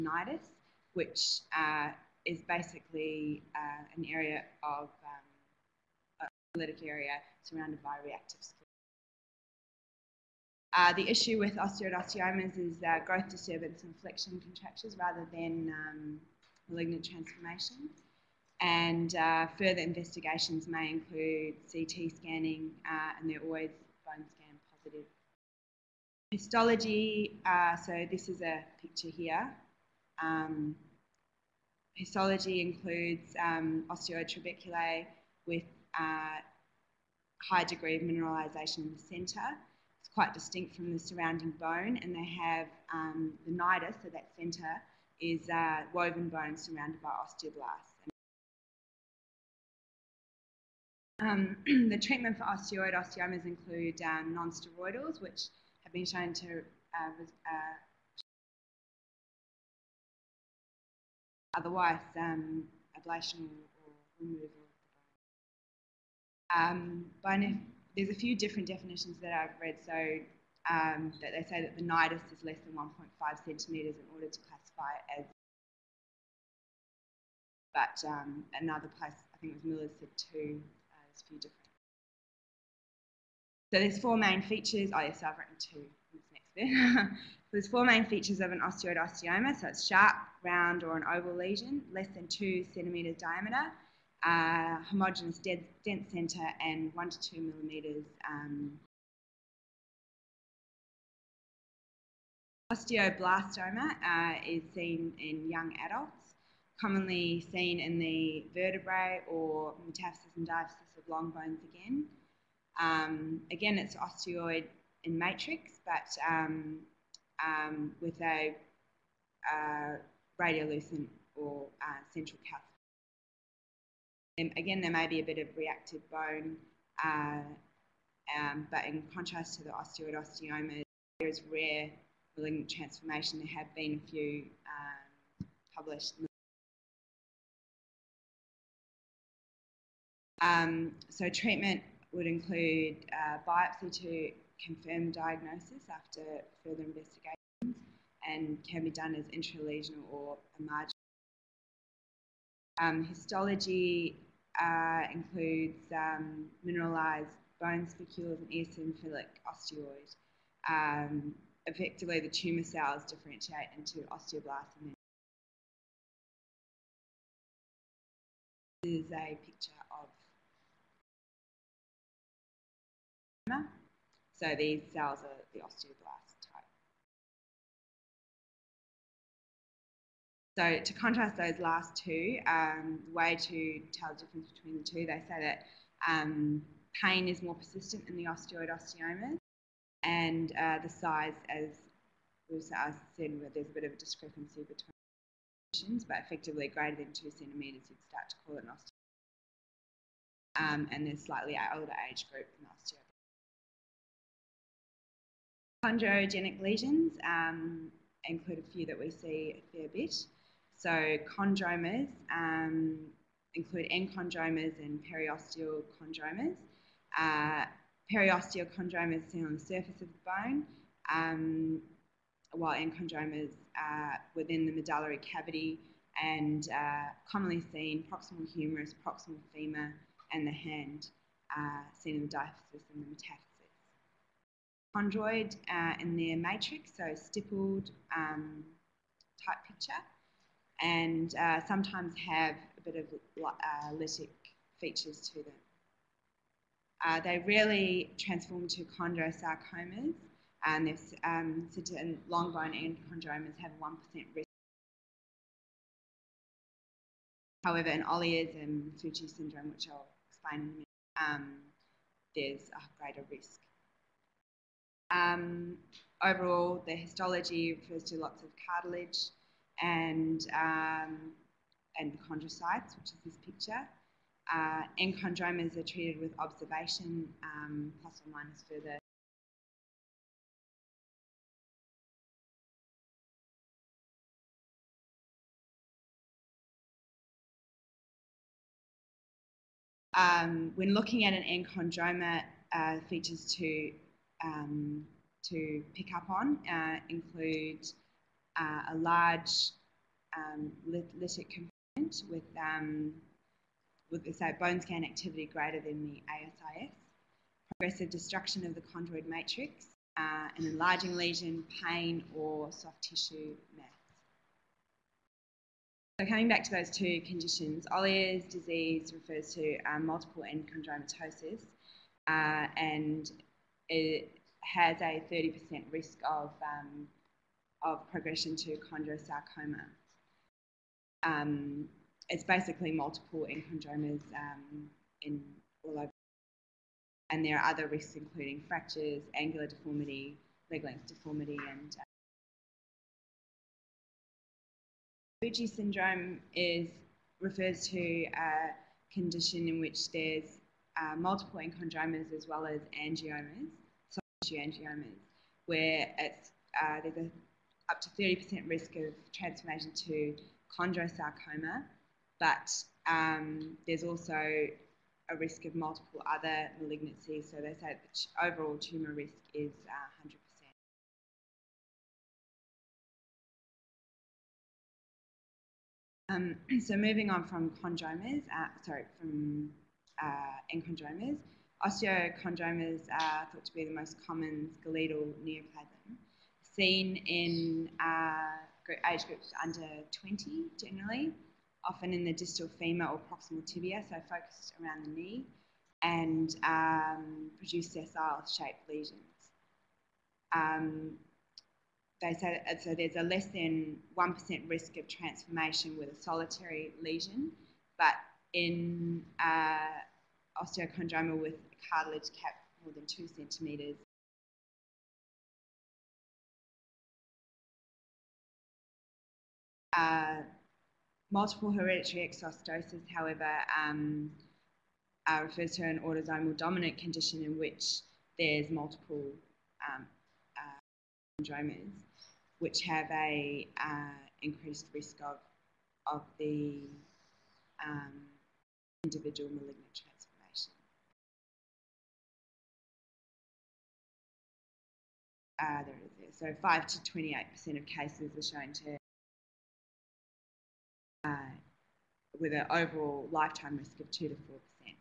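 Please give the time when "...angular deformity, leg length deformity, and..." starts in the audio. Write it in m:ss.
5:39.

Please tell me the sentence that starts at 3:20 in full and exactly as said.
Um, and there's slightly older age group in osteoid.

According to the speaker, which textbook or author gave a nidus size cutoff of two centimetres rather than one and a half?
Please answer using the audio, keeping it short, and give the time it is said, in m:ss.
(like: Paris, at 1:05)
Miller, at 1:19.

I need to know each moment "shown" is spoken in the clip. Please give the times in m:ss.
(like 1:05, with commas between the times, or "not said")
0:56, 7:28.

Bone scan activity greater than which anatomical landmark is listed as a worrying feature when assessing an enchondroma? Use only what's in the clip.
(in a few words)
ASIS.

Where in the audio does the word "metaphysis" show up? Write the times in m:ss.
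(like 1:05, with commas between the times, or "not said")
1:49, 3:53.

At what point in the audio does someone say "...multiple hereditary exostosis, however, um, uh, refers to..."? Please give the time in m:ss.
7:01.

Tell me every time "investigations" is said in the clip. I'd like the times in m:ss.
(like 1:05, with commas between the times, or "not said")
0:19, 2:26.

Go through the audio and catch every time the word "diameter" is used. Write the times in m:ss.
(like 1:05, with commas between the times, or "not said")
1:33.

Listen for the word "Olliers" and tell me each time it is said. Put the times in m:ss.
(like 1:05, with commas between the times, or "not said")
4:18, 5:17.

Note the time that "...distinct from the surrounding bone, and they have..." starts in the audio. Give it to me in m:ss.
0:40.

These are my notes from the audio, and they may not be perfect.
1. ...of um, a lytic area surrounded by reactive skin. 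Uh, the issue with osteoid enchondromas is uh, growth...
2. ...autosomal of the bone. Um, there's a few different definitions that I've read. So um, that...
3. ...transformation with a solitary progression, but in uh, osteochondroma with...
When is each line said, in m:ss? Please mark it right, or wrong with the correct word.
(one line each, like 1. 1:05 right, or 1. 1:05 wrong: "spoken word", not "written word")
1. 0:04 wrong: "osteomas", not "enchondromas"
2. 1:04 wrong: "removal", not "autosomal"
3. 6:45 wrong: "lesion", not "progression".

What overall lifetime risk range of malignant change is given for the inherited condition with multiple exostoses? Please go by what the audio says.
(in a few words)
2 to 4%.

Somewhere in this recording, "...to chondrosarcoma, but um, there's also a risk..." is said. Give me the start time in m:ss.
6:00.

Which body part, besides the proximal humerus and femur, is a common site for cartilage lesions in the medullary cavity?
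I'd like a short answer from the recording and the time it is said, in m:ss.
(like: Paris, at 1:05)
The hand, at 3:50.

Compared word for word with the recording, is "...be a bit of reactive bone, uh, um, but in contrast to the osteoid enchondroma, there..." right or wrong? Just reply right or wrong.
wrong.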